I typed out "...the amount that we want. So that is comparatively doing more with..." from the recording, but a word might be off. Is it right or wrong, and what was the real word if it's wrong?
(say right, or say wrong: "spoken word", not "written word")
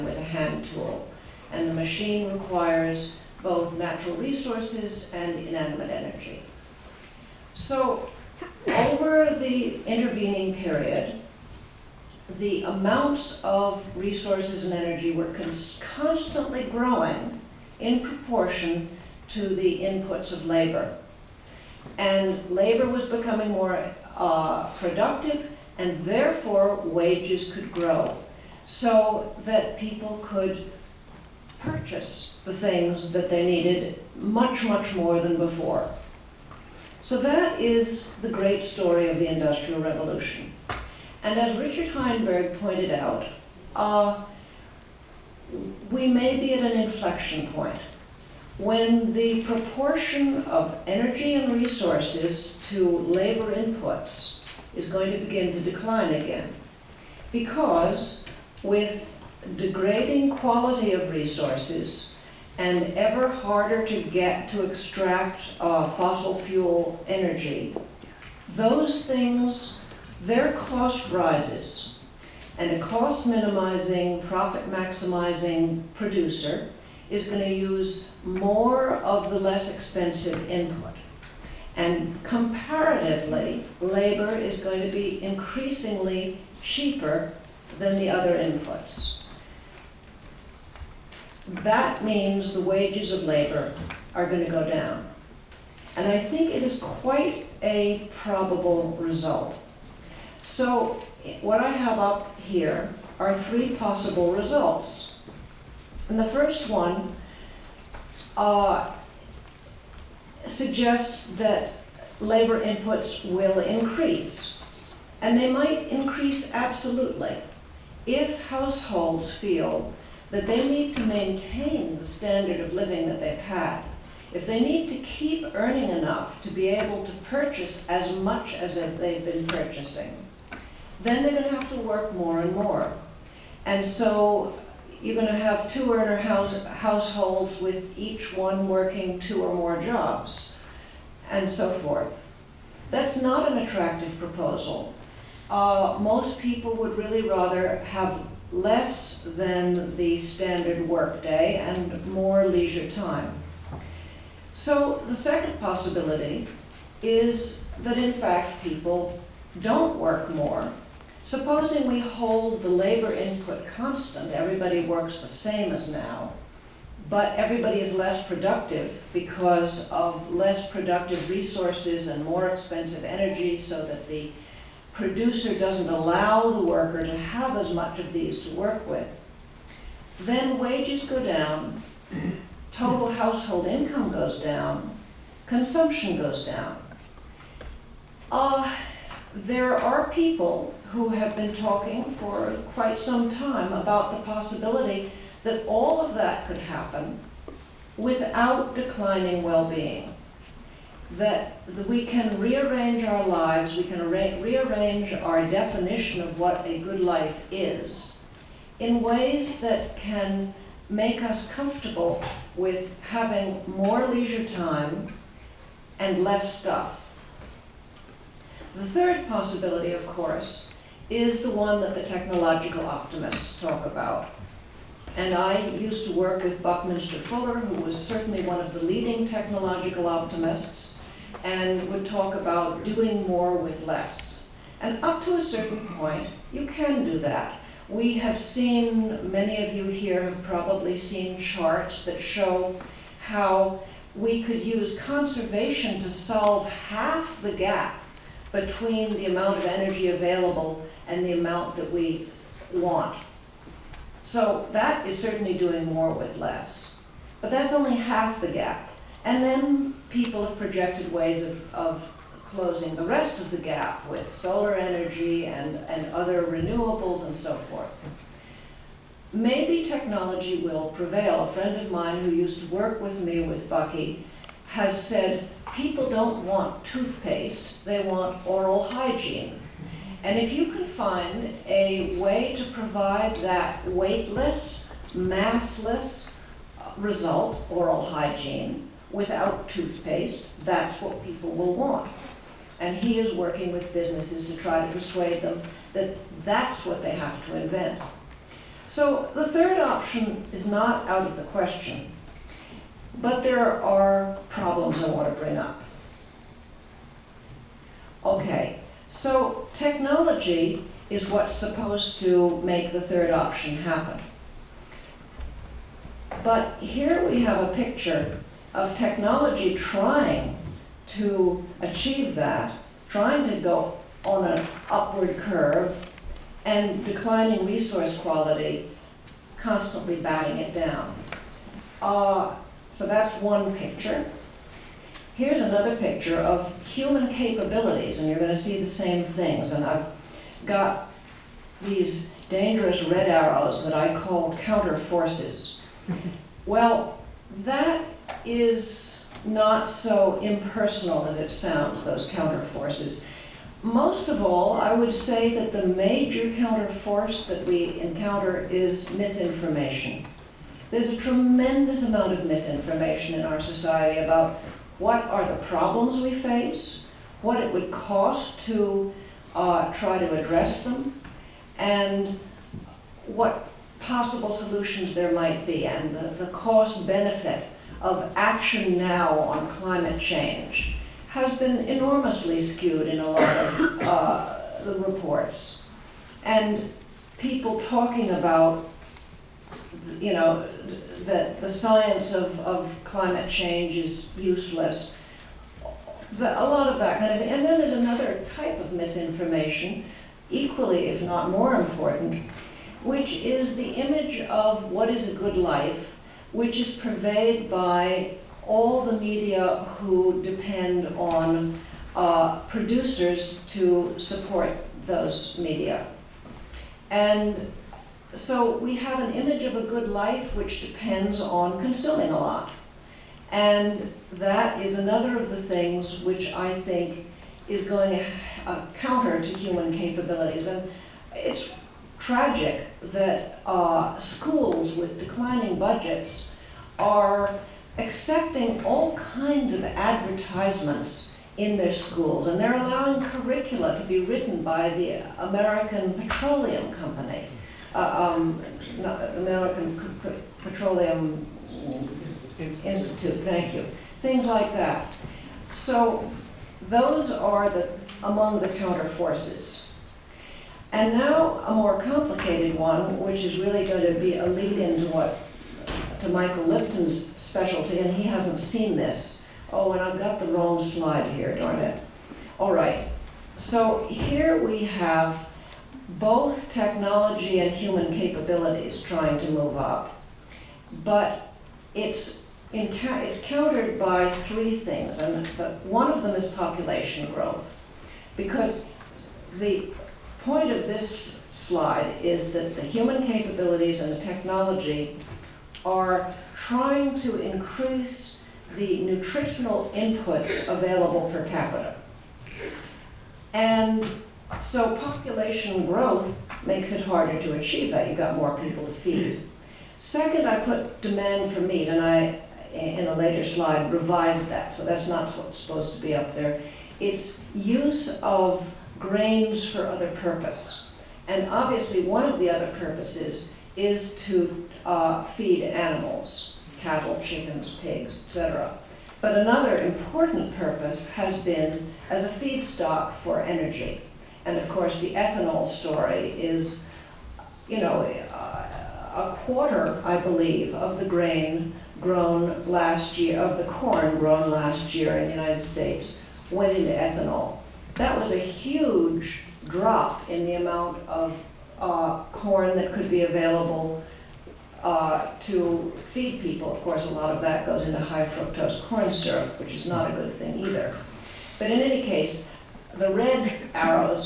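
wrong: "certainly", not "comparatively".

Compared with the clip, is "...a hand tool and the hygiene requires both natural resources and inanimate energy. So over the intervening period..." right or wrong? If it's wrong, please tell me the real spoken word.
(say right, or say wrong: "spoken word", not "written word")
wrong: "machine", not "hygiene".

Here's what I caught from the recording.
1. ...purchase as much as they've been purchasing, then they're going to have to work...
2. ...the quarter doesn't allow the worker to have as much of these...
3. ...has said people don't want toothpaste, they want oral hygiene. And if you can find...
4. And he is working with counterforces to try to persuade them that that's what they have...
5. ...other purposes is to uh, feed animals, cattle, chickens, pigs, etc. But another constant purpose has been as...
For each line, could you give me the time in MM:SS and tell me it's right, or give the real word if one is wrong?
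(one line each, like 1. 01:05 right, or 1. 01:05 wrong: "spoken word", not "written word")
1. 02:07 right
2. 02:54 wrong: "producer", not "quarter"
3. 04:34 right
4. 04:52 wrong: "businesses", not "counterforces"
5. 08:42 wrong: "important", not "constant".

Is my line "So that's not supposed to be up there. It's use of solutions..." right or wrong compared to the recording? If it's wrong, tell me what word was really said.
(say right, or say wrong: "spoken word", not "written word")
wrong: "grains", not "solutions".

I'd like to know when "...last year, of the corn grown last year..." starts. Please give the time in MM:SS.
09:02.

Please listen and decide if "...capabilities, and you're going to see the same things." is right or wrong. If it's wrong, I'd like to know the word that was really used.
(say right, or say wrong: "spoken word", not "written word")
right.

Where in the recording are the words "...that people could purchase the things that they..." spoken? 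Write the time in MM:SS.
00:29.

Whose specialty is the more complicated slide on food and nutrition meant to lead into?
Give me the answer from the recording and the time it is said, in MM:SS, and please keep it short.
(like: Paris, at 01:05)
Michael Lipton, at 07:46.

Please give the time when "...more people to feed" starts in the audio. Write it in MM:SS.
08:28.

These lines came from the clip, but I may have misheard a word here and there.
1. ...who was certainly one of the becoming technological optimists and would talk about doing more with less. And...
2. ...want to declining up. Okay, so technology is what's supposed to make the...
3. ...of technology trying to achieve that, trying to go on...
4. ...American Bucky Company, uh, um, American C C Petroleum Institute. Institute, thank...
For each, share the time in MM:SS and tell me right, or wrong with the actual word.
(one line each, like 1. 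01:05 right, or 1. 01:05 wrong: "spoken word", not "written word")
1. 03:47 wrong: "leading", not "becoming"
2. 05:05 wrong: "bring", not "declining"
3. 05:18 right
4. 07:25 wrong: "Petroleum", not "Bucky".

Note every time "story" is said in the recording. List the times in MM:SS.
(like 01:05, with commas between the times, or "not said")
00:38, 08:55.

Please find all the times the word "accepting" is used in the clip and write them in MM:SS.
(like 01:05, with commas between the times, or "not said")
07:17.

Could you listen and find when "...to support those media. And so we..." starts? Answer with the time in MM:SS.
06:53.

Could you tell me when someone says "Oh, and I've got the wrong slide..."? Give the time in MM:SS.
07:49.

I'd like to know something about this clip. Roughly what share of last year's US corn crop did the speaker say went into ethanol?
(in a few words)
a quarter.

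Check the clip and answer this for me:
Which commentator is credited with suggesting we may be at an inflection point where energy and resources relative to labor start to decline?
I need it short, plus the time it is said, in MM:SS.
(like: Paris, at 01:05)
Richard Heinberg, at 00:41.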